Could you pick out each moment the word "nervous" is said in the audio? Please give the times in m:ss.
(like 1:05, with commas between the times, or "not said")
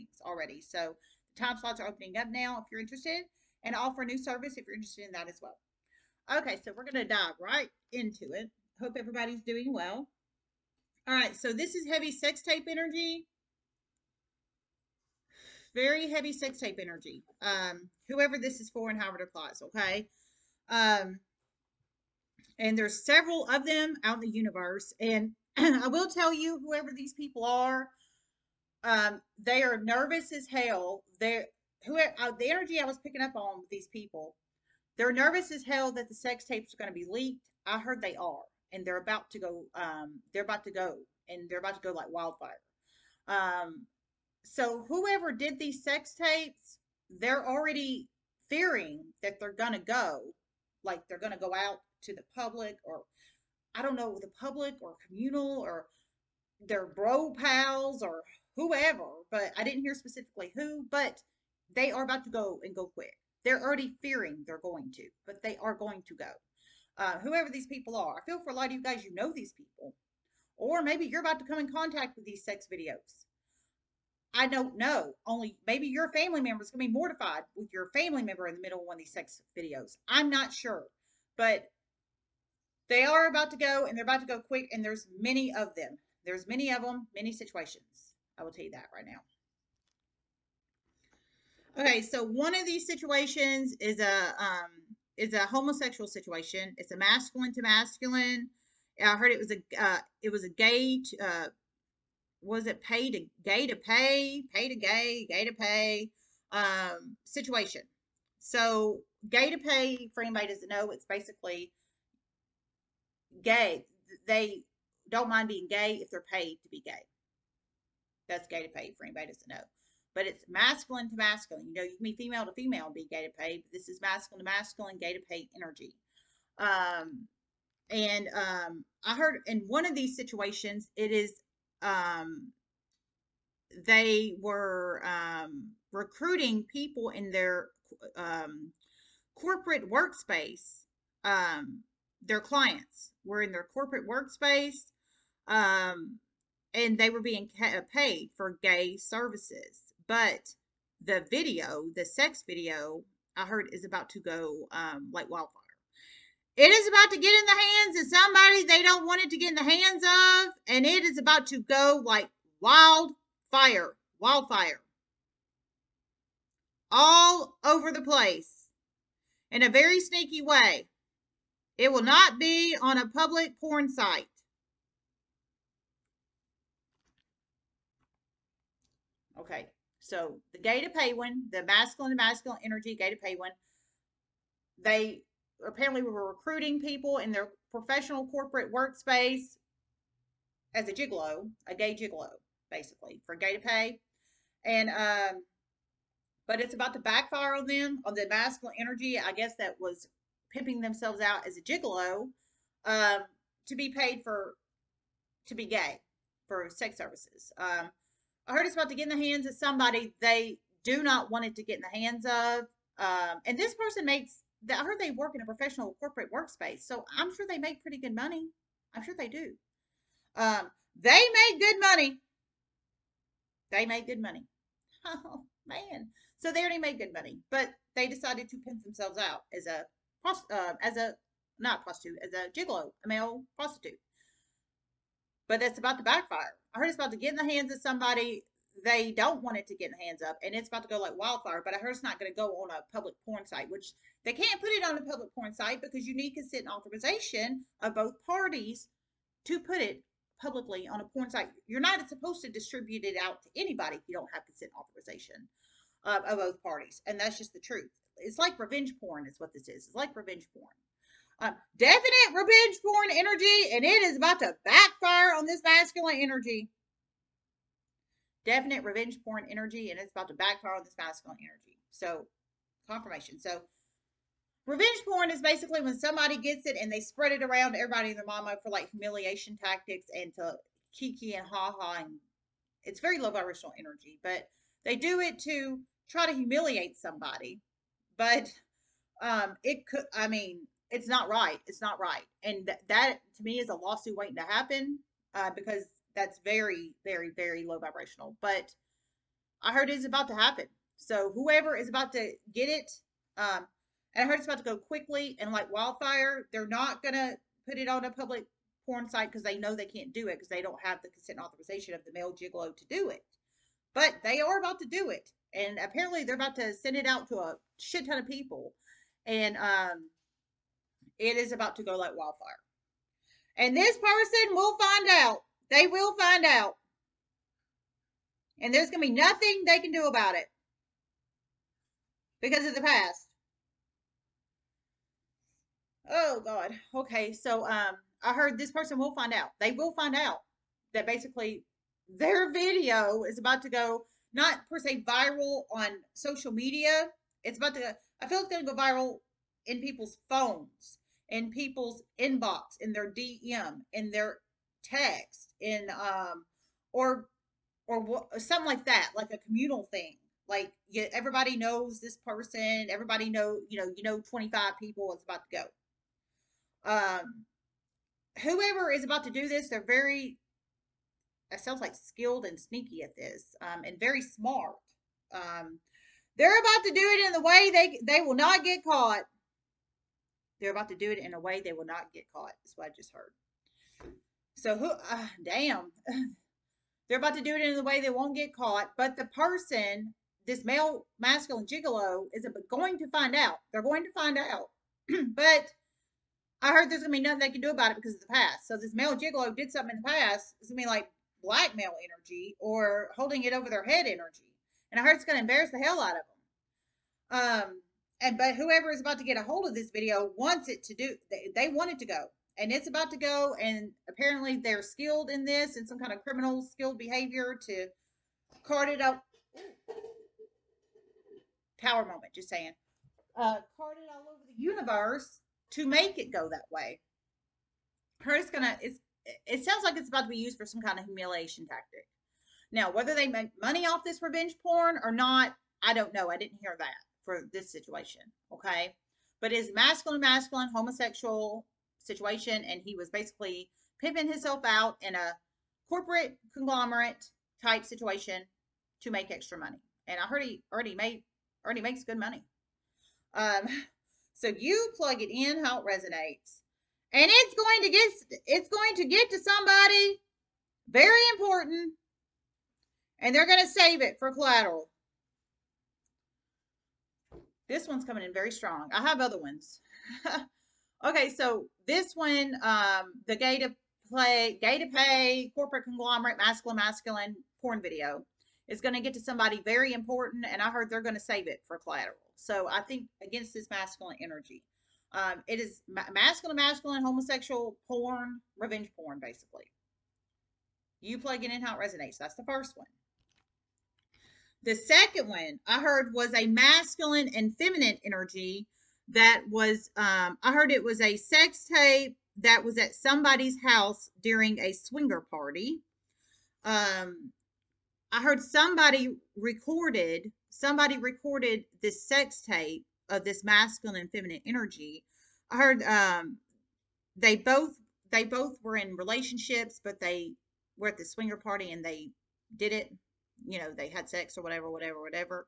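0:29, 0:35.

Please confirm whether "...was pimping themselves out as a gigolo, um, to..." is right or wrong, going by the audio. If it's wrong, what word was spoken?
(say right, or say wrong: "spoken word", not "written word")
right.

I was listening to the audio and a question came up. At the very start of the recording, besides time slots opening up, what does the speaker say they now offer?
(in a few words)
a new service.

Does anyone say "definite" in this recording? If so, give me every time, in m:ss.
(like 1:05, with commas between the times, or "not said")
4:21, 4:28.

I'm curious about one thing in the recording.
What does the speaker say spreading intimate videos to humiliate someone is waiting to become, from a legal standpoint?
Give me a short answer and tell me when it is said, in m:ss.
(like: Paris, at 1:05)
a lawsuit, at 4:53.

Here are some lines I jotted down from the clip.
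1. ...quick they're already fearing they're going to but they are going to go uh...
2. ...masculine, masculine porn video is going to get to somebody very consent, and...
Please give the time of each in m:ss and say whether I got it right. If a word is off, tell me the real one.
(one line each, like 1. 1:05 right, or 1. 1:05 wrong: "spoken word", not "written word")
1. 1:02 right
2. 7:56 wrong: "important", not "consent".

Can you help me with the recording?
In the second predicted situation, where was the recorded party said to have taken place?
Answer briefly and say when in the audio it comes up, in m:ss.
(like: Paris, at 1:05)
somebody's house, at 8:22.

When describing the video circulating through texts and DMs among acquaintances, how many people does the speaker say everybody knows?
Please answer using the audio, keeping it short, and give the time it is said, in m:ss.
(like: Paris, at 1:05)
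25, at 6:04.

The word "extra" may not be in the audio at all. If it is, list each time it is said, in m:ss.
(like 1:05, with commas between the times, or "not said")
7:29.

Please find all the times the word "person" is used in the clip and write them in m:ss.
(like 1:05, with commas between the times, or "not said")
3:33, 5:23, 5:38, 6:02, 6:29.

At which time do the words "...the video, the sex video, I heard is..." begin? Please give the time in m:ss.
2:31.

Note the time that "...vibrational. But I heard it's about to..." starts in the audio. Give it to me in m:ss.
4:57.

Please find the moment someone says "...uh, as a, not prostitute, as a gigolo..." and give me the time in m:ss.
3:50.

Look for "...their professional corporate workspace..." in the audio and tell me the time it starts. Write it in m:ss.
3:07.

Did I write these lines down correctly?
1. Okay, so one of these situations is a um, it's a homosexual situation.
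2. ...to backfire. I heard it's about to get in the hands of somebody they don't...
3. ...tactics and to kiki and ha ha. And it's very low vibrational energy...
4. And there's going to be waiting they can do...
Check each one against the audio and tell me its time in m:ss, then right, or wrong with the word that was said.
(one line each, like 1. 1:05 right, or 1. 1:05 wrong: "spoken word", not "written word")
1. 1:31 right
2. 3:55 right
3. 4:39 right
4. 5:28 wrong: "nothing", not "waiting".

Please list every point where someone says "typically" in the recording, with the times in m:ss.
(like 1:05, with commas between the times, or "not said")
not said.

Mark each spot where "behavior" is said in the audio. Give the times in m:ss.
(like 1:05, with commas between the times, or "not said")
6:56.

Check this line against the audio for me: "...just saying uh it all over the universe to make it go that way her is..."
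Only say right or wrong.
right.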